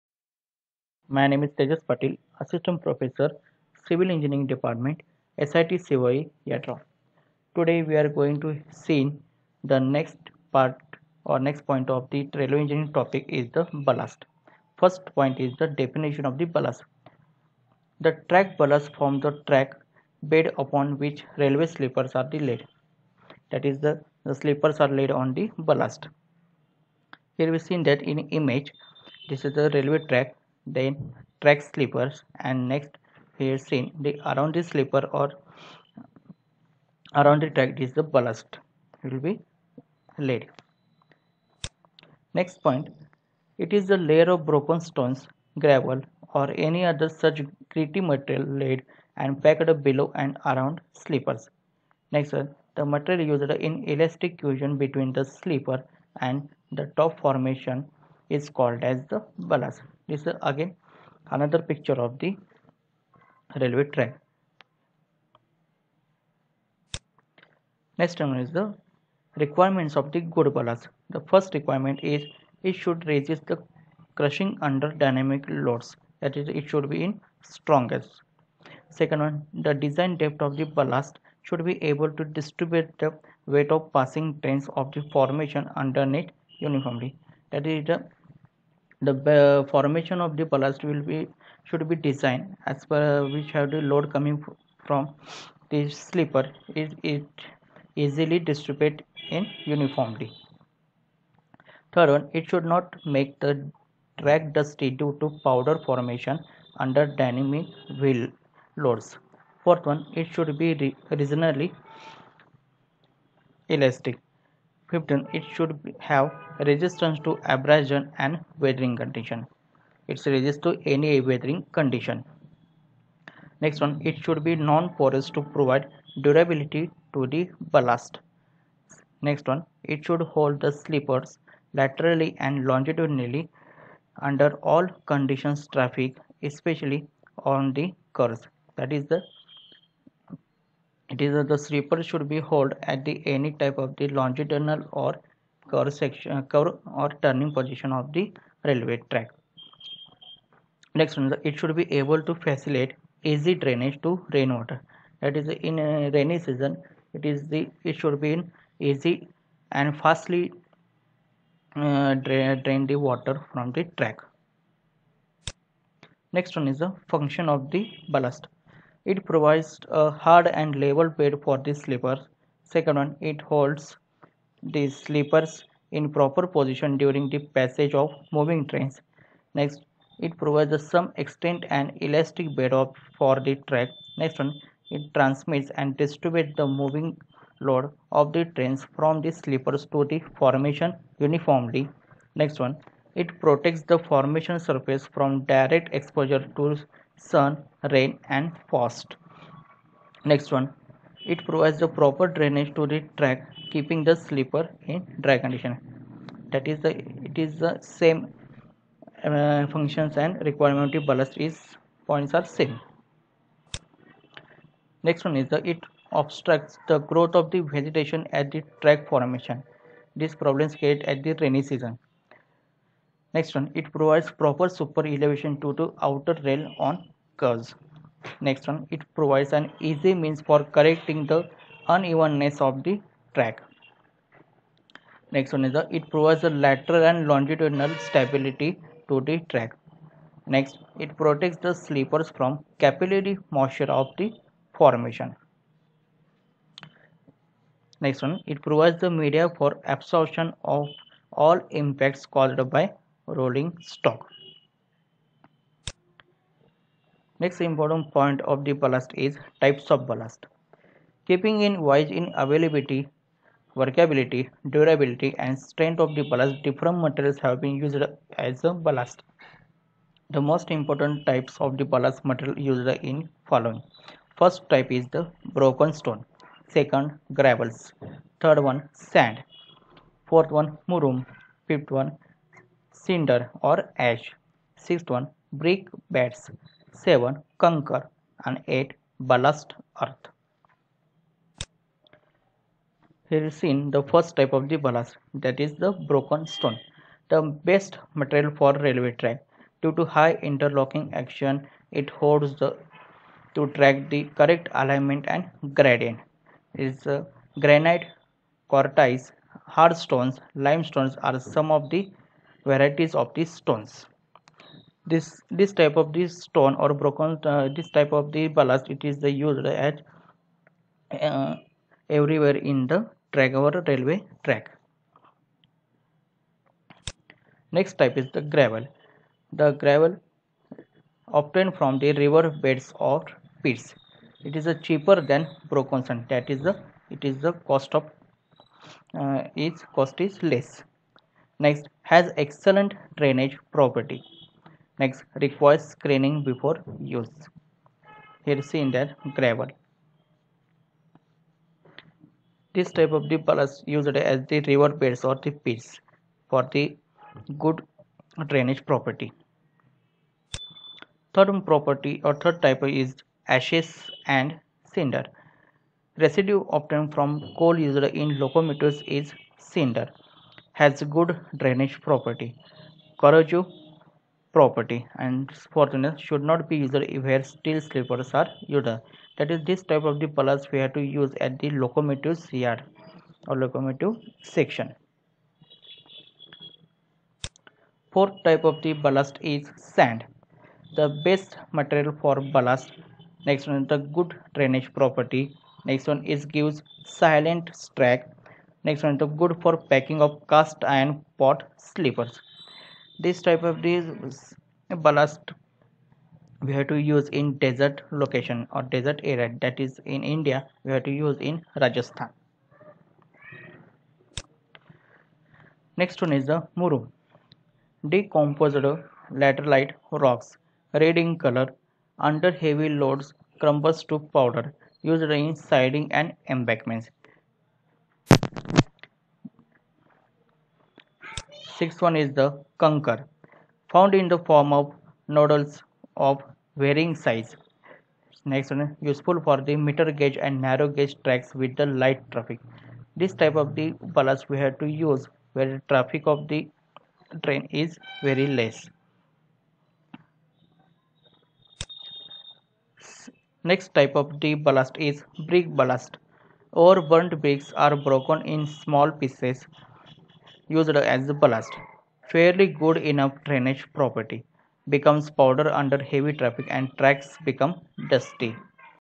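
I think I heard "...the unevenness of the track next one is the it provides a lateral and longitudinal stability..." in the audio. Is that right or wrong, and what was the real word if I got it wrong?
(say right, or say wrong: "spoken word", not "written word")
right.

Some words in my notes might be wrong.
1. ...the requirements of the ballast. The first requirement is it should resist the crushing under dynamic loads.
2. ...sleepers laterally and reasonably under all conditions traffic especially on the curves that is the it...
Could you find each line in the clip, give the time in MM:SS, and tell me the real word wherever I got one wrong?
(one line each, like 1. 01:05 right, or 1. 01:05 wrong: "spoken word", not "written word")
1. 01:08 right
2. 02:10 wrong: "longitudinally", not "reasonably".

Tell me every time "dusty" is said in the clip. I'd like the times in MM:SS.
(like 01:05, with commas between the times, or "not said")
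01:44, 07:48.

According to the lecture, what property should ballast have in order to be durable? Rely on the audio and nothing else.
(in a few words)
Non-porous.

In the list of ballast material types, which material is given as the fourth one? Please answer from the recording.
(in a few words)
Murum.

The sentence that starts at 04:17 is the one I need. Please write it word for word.
Next important point of the ballast is types of ballast.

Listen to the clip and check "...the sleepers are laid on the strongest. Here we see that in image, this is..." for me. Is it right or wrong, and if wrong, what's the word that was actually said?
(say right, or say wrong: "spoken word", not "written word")
wrong: "ballast", not "strongest".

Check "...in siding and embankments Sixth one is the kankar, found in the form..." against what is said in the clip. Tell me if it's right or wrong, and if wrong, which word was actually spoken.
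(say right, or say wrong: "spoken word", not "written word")
right.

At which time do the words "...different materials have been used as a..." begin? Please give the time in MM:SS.
04:26.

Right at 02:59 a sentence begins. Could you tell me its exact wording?
Next, it provides some extent and elastic bed of, for the track.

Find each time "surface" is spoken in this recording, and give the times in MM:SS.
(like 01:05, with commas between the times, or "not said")
03:14.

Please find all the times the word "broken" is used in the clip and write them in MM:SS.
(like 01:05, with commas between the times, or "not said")
00:44, 04:35, 04:55, 05:16, 05:35, 07:37.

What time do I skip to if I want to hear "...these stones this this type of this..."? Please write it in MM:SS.
05:13.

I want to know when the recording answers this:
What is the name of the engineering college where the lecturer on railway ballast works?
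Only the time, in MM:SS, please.
00:05.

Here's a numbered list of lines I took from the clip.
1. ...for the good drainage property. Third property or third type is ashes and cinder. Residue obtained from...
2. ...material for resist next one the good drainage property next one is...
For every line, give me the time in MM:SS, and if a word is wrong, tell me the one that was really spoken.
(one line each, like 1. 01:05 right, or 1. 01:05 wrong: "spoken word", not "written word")
1. 05:56 right
2. 06:31 wrong: "ballast", not "resist".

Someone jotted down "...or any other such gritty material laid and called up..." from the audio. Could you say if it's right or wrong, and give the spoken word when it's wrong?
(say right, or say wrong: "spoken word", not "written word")
wrong: "packed", not "called".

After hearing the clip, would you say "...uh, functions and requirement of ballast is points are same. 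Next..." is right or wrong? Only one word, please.
right.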